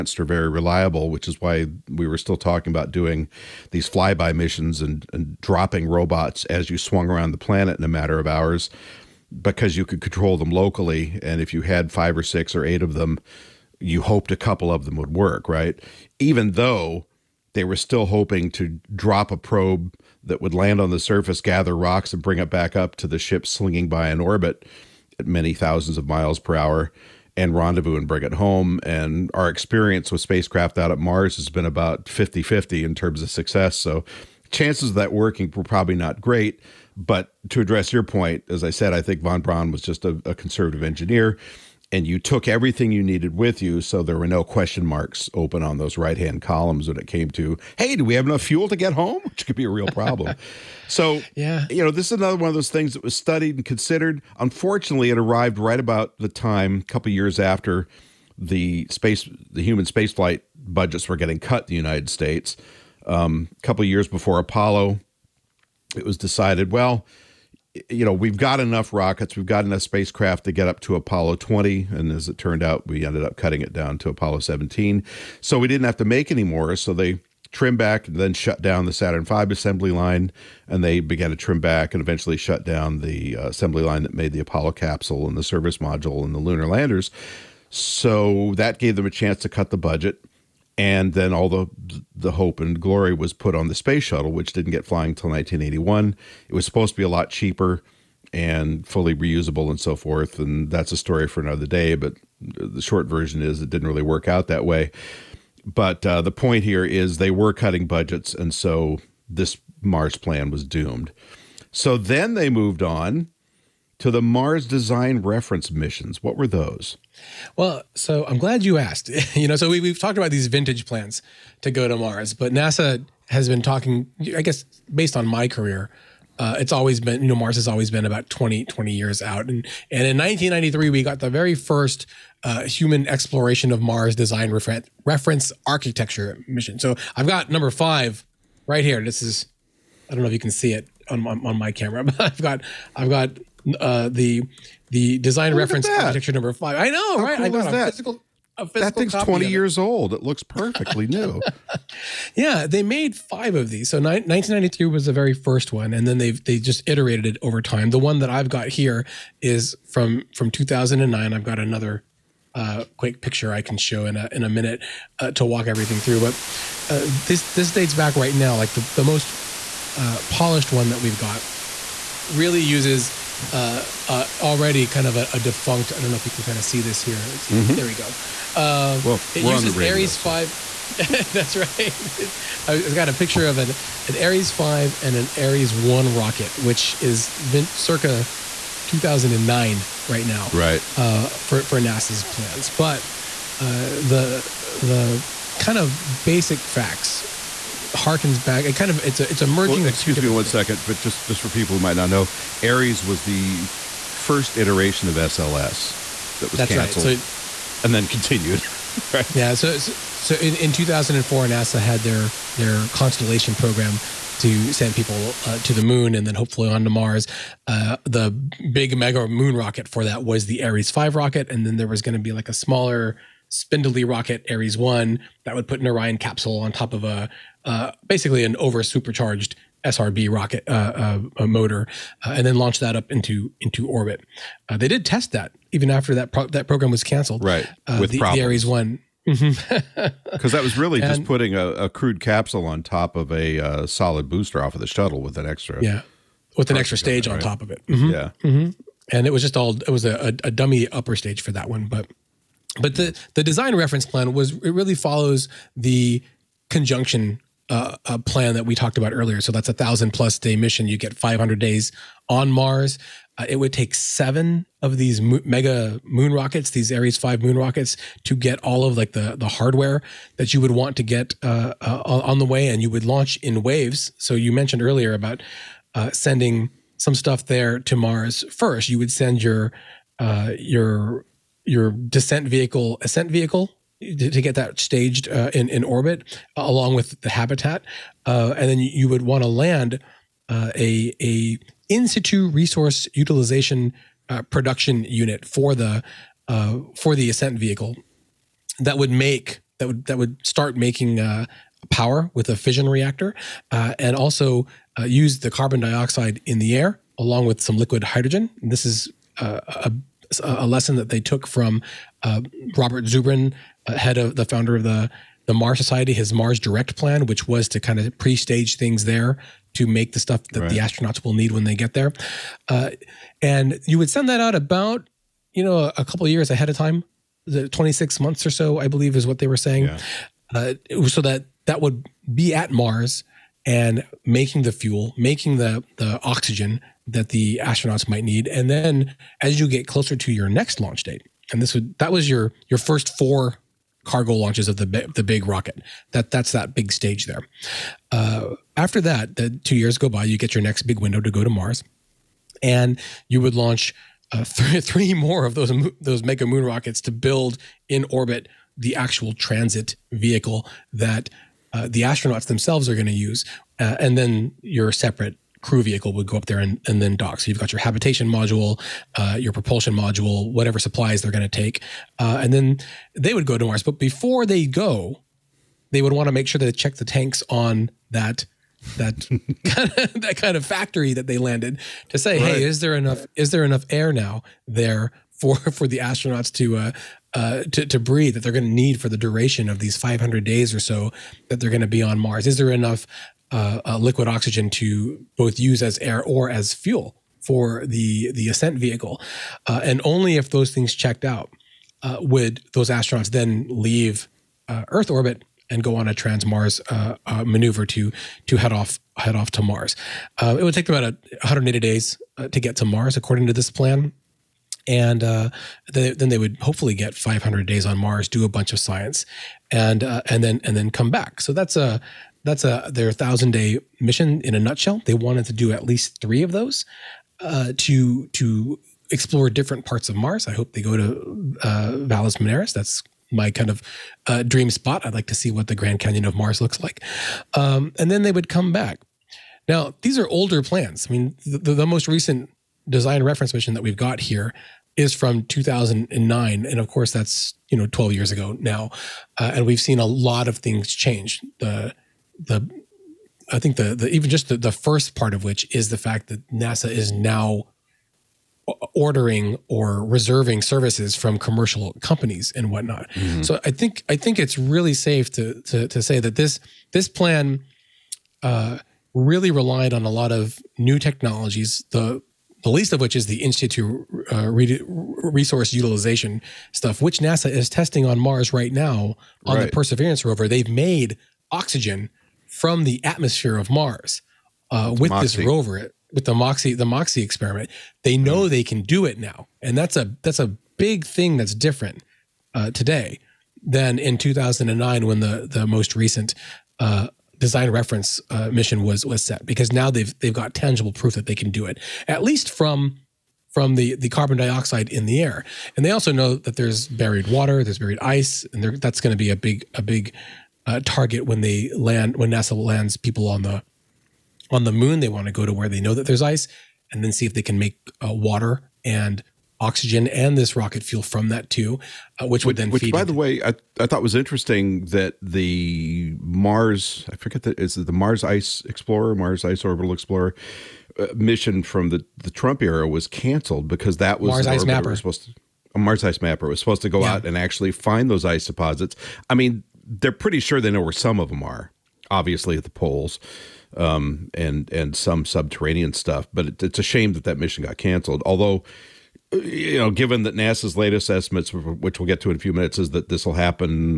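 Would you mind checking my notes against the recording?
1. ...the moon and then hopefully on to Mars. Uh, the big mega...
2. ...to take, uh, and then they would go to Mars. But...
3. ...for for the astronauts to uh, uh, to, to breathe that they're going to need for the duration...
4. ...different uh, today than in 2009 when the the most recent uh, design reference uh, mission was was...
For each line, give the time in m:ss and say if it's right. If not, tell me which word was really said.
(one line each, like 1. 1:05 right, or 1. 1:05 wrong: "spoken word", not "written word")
1. 3:35 right
2. 6:11 right
3. 6:25 right
4. 8:11 right.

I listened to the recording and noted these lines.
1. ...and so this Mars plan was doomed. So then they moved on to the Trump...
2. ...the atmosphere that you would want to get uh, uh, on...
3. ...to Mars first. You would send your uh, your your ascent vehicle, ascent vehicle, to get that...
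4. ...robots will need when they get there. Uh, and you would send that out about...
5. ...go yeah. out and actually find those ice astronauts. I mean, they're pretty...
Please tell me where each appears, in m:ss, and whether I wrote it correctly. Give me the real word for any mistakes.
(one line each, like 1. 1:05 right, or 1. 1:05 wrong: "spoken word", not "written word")
1. 1:48 wrong: "Mars", not "Trump"
2. 4:29 wrong: "hardware", not "atmosphere"
3. 4:37 wrong: "descent", not "ascent"
4. 5:20 wrong: "astronauts", not "robots"
5. 8:56 wrong: "deposits", not "astronauts".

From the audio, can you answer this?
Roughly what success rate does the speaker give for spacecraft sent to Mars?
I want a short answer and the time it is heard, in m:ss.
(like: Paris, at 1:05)
50 50, at 0:32.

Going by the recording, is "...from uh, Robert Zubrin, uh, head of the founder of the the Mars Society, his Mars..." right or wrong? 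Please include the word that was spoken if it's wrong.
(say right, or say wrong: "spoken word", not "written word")
right.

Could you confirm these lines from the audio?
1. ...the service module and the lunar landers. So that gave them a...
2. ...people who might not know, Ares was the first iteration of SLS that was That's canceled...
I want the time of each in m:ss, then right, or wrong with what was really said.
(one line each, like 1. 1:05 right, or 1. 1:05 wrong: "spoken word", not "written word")
1. 1:25 right
2. 3:21 right.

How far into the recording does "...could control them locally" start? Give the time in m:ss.
0:09.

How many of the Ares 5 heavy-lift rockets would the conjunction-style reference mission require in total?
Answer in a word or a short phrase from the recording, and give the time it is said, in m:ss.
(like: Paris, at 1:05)
7, at 4:23.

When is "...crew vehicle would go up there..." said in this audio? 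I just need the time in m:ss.
6:05.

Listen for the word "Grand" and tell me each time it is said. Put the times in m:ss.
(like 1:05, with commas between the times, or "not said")
7:15.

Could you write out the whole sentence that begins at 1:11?
And as it turned out, we ended up cutting it down to Apollo 17.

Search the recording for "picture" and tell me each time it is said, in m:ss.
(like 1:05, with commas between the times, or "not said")
2:43, 3:03.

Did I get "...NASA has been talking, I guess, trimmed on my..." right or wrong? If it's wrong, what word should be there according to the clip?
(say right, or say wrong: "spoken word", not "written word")
wrong: "based", not "trimmed".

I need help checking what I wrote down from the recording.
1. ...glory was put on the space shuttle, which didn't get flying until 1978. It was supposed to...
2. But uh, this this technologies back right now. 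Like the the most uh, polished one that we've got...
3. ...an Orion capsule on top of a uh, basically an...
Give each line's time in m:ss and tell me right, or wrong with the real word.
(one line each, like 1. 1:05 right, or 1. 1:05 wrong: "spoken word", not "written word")
1. 1:32 wrong: "1981", not "1978"
2. 2:46 wrong: "dates", not "technologies"
3. 3:45 right.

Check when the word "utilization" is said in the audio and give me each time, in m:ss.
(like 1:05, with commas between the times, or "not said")
4:53, 7:55.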